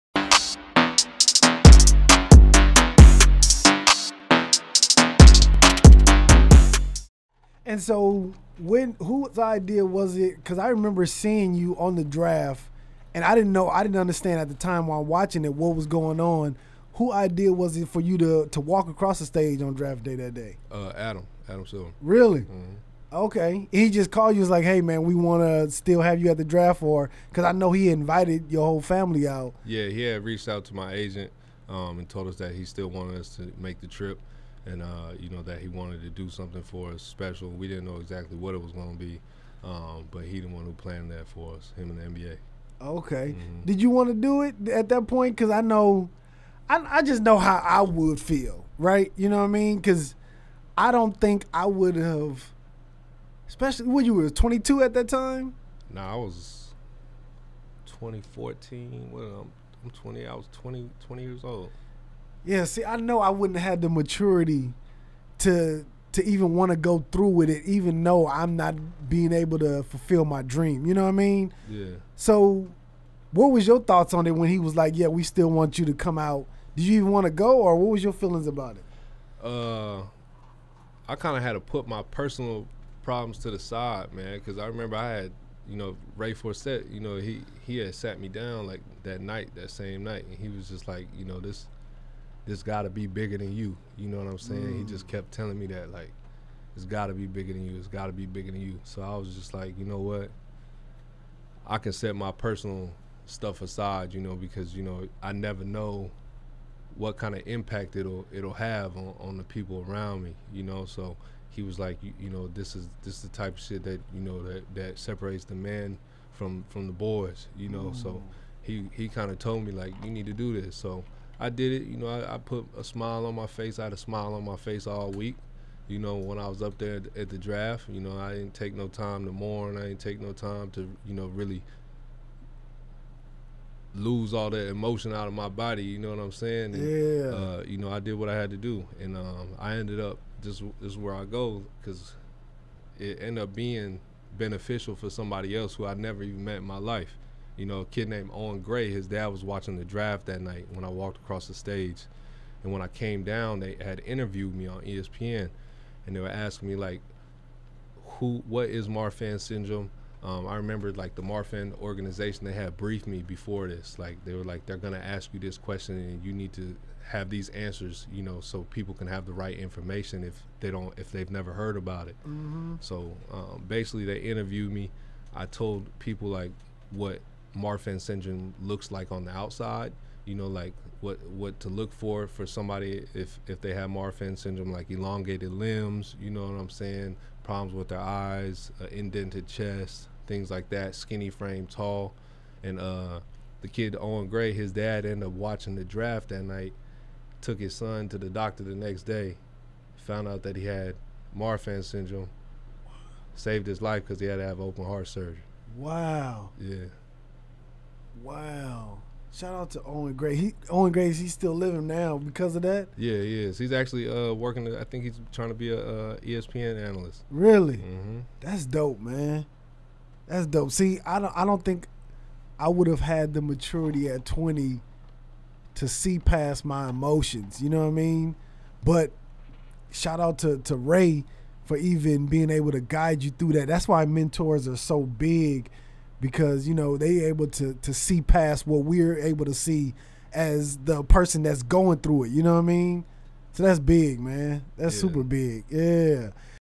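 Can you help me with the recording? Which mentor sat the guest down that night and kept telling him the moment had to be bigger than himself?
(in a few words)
Ray Forsett.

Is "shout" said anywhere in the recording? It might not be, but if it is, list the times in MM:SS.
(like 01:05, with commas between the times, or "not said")
03:29, 03:49.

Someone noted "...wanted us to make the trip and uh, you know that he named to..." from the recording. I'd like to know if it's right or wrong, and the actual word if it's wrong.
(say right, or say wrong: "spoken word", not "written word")
wrong: "wanted", not "named".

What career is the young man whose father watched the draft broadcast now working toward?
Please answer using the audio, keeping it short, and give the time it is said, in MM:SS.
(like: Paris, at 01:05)
ESPN analyst, at 03:36.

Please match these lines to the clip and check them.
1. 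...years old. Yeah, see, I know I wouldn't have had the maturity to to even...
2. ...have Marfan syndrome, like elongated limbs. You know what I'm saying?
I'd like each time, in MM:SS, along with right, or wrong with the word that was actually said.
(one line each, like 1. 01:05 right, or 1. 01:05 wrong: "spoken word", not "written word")
1. 01:01 right
2. 03:03 right.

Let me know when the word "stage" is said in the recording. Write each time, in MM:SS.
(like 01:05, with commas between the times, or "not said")
00:19, 02:31.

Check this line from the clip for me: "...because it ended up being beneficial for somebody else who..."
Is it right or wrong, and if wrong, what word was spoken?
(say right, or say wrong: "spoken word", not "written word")
right.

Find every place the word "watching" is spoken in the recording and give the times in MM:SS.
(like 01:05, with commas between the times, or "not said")
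00:15, 02:29, 03:15.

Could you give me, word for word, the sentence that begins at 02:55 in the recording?
I told people like what Marfan syndrome looks like on the outside.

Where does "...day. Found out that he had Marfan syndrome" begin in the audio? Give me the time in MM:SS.
03:19.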